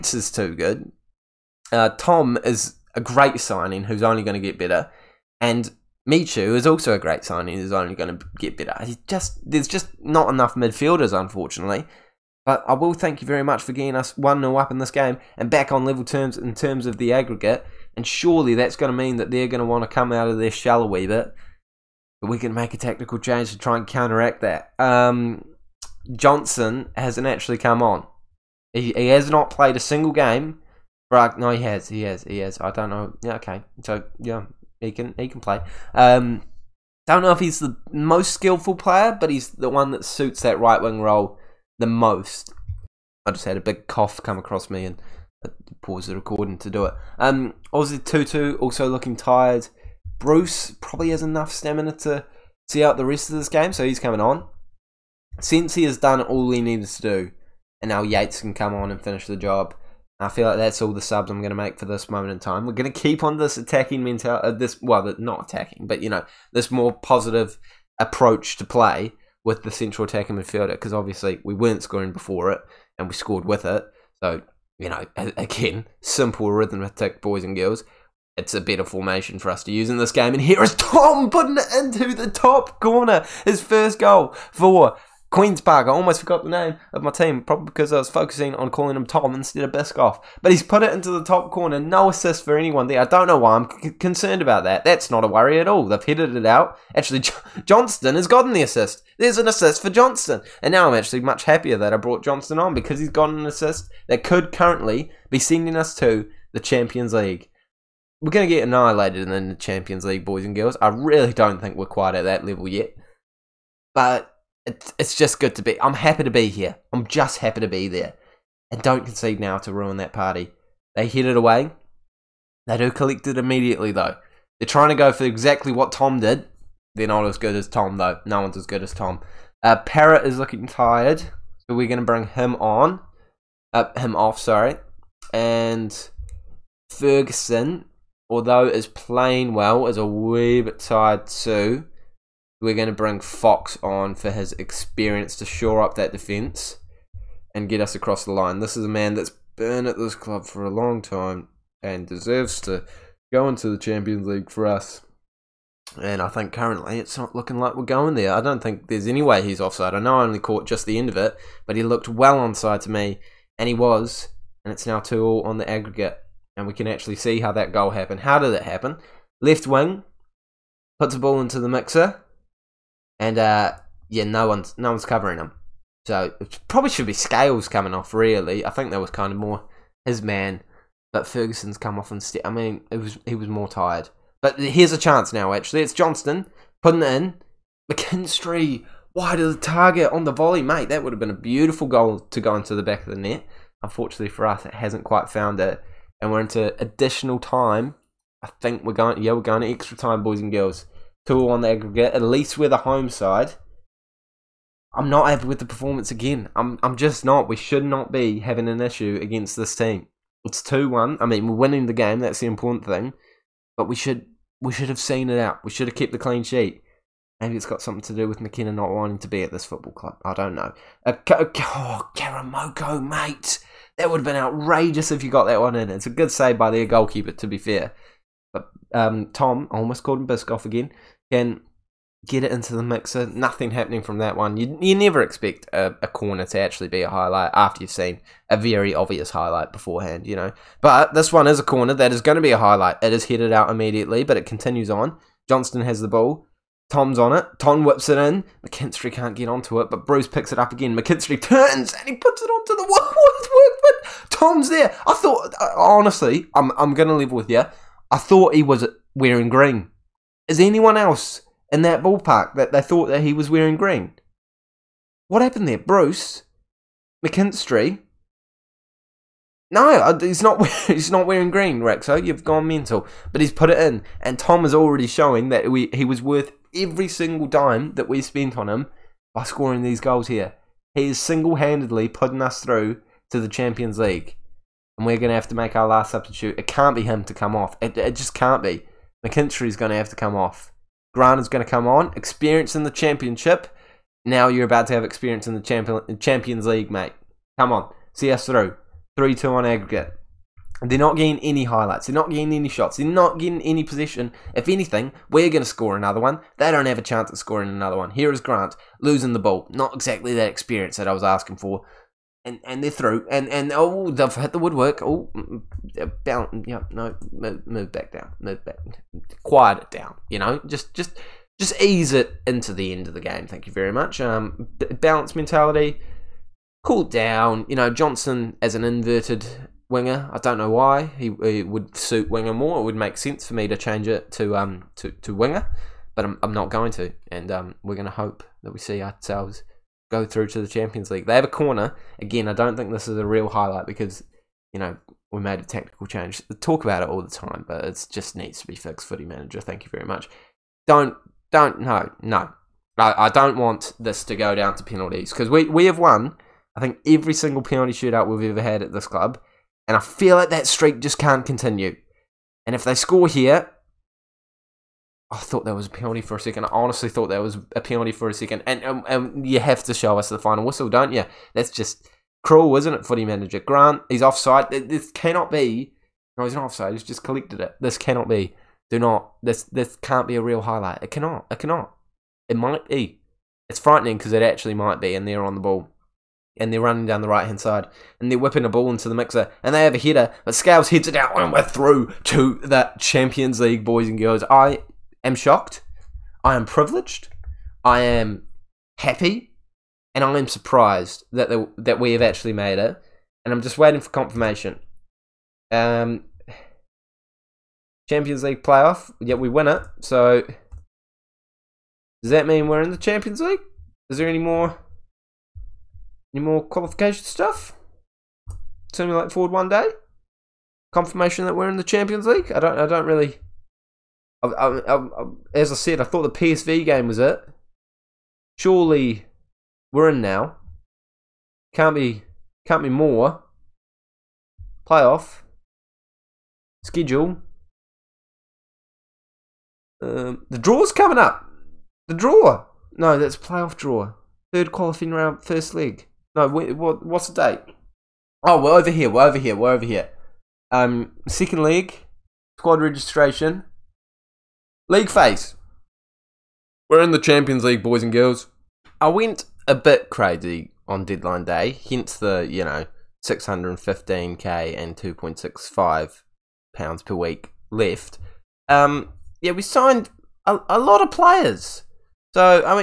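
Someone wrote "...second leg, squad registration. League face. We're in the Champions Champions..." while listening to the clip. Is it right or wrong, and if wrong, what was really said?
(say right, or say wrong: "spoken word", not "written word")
wrong: "League", not "Champions".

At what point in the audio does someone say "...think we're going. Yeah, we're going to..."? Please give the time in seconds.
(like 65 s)
198 s.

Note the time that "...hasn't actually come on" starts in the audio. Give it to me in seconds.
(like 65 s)
26 s.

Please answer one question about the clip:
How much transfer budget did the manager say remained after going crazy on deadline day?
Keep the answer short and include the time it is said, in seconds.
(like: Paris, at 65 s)
615k, at 463 s.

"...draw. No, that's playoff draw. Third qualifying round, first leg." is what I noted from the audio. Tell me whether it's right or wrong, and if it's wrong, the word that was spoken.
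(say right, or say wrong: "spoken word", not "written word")
right.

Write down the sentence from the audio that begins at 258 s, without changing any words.
I thought he was wearing green.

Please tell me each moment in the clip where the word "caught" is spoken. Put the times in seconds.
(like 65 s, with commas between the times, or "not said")
160 s.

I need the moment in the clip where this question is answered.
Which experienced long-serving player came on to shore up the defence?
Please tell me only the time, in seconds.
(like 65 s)
143 s.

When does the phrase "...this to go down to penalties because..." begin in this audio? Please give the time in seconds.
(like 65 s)
353 s.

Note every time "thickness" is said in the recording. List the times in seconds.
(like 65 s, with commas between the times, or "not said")
not said.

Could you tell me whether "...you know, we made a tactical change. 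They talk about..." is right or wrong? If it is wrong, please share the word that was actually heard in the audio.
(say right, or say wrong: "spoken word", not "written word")
right.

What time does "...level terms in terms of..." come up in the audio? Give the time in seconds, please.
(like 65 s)
15 s.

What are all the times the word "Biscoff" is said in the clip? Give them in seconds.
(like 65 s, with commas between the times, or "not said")
89 s, 230 s.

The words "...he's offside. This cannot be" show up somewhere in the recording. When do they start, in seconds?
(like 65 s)
374 s.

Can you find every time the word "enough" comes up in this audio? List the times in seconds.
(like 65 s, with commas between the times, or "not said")
10 s, 51 s.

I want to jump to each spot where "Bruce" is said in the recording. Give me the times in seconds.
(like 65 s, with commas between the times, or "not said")
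50 s, 250 s, 265 s.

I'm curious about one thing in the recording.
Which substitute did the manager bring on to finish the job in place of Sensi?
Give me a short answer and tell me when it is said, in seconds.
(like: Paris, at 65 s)
Yates, at 58 s.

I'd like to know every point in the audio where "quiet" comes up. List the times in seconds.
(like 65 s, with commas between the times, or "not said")
319 s.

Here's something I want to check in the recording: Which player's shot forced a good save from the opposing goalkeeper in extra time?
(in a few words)
Karamoko.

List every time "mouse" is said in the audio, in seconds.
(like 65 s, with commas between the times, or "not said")
not said.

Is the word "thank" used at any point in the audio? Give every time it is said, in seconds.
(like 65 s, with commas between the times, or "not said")
12 s, 323 s, 349 s.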